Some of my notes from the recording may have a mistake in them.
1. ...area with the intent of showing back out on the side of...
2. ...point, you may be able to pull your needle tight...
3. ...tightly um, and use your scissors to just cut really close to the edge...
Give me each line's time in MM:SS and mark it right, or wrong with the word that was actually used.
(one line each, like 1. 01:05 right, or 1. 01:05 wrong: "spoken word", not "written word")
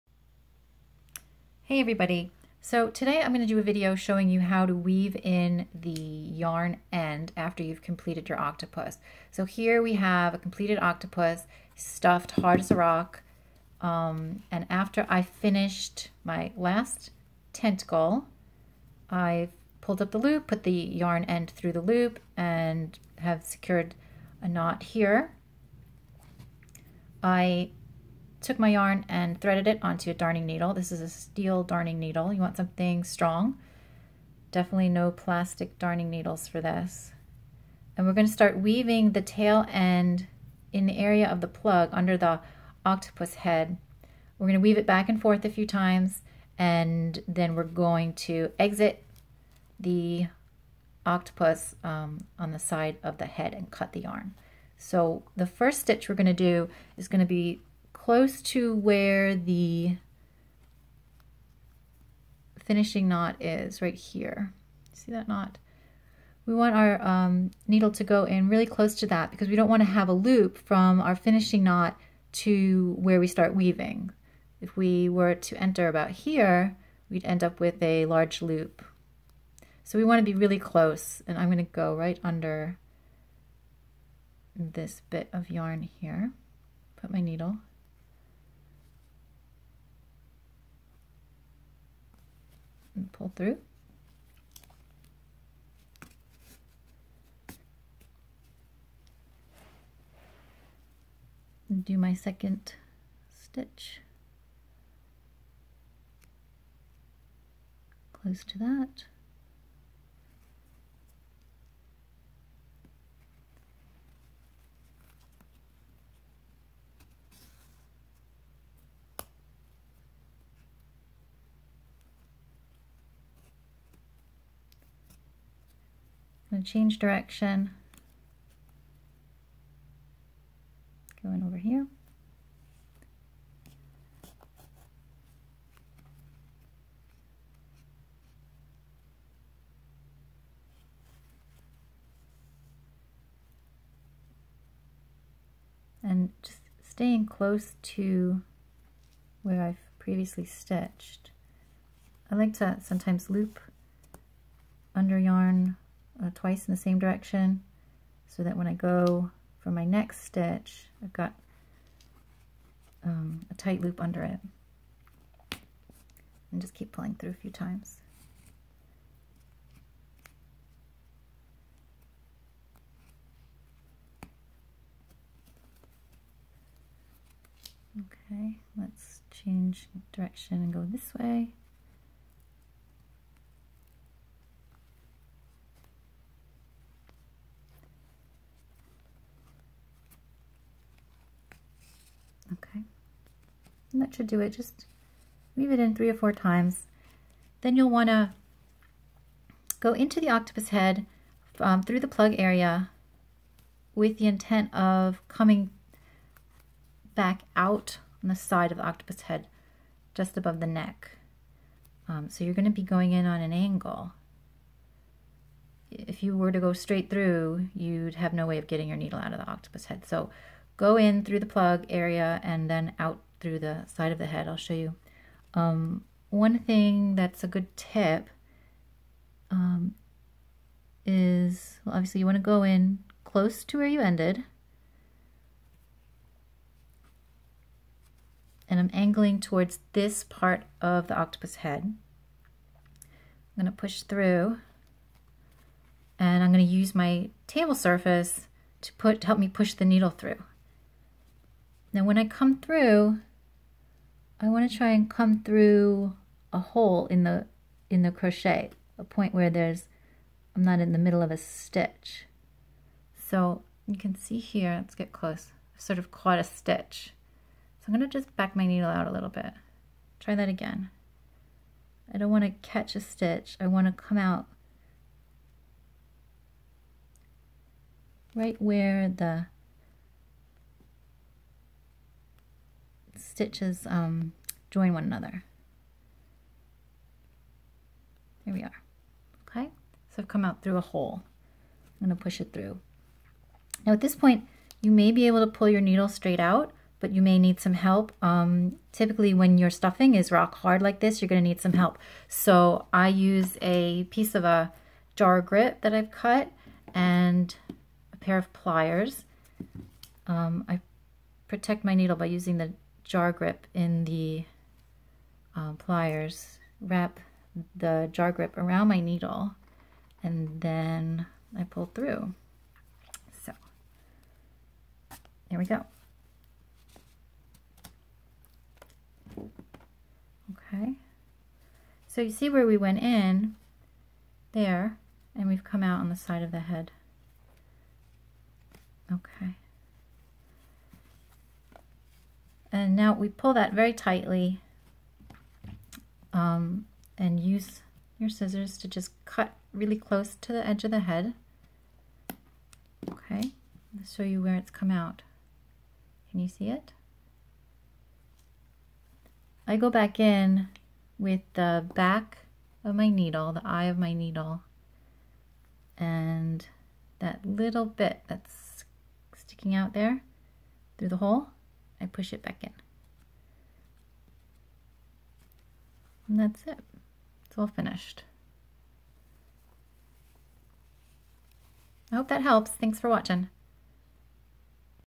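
1. 03:22 wrong: "coming", not "showing"
2. 04:54 wrong: "straight", not "tight"
3. 05:43 right.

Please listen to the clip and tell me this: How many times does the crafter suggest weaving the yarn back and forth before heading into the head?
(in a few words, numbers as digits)
3 or 4.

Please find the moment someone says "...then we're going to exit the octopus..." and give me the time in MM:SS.
00:47.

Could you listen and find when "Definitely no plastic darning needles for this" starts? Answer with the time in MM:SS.
00:34.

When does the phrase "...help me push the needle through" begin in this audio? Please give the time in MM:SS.
04:09.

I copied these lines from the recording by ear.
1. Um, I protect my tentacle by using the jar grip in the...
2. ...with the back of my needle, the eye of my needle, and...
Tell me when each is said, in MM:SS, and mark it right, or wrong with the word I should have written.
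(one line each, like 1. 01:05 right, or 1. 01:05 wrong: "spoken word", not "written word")
1. 05:10 wrong: "needle", not "tentacle"
2. 06:01 right.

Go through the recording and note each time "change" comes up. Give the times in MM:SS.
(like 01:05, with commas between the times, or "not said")
02:06, 02:59.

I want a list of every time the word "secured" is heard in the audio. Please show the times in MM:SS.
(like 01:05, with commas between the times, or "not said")
00:23.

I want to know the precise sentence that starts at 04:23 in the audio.
So you can see here, let's get close, I've sort of caught a stitch.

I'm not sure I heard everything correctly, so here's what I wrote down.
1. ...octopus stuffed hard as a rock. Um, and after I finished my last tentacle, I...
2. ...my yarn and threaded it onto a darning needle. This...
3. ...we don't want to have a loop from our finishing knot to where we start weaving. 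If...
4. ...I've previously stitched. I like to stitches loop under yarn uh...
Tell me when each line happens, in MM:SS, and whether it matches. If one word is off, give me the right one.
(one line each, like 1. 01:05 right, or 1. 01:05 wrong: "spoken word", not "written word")
1. 00:10 right
2. 00:28 right
3. 01:09 right
4. 02:29 wrong: "sometimes", not "stitches".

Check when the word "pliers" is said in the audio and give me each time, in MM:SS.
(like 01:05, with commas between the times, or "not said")
05:08, 05:15.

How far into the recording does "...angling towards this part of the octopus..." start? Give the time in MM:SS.
03:58.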